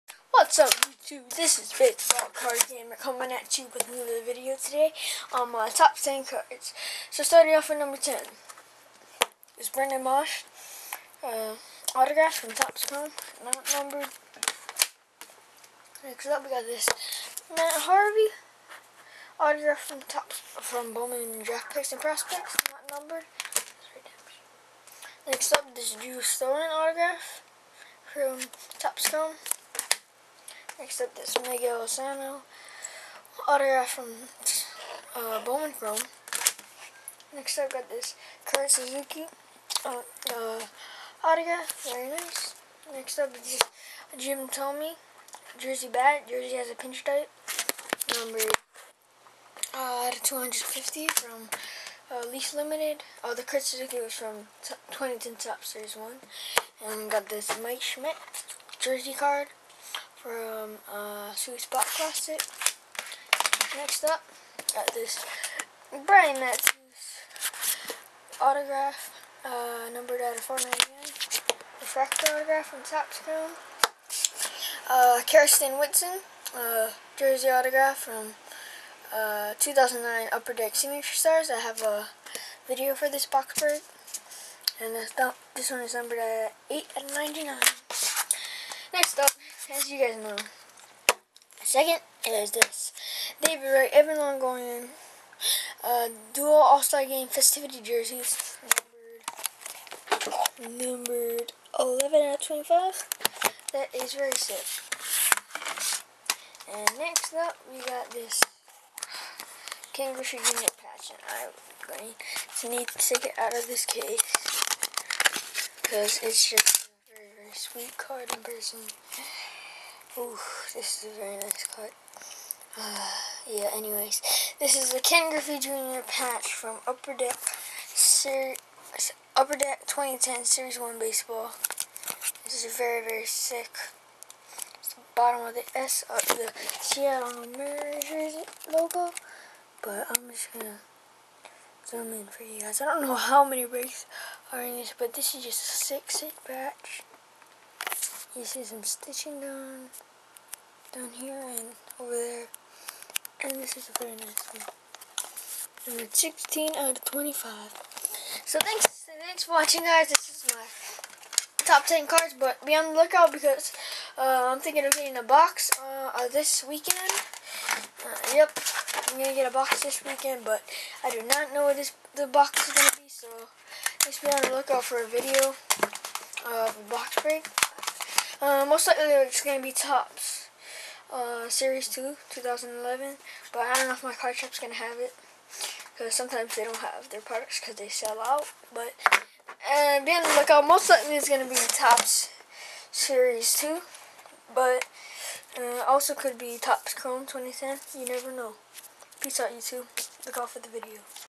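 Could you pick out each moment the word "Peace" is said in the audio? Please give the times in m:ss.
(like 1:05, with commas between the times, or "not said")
3:19.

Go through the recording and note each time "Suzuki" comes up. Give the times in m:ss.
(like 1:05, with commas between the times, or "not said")
0:38, 0:53.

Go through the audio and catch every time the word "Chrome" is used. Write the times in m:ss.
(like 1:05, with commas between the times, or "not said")
0:12, 0:29, 0:35, 3:16.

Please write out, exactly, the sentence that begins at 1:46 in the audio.
And next up, we got this Kangaroo Unit patch.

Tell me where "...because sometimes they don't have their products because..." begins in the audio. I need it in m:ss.
3:05.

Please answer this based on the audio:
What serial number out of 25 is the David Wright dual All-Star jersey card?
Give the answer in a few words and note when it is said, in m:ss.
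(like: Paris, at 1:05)
11, at 1:41.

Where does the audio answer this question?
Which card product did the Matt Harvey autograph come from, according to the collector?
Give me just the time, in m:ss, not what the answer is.
0:20.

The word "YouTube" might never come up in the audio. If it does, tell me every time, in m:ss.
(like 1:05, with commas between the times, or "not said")
0:01, 3:19.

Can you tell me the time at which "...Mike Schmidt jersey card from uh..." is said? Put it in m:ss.
0:57.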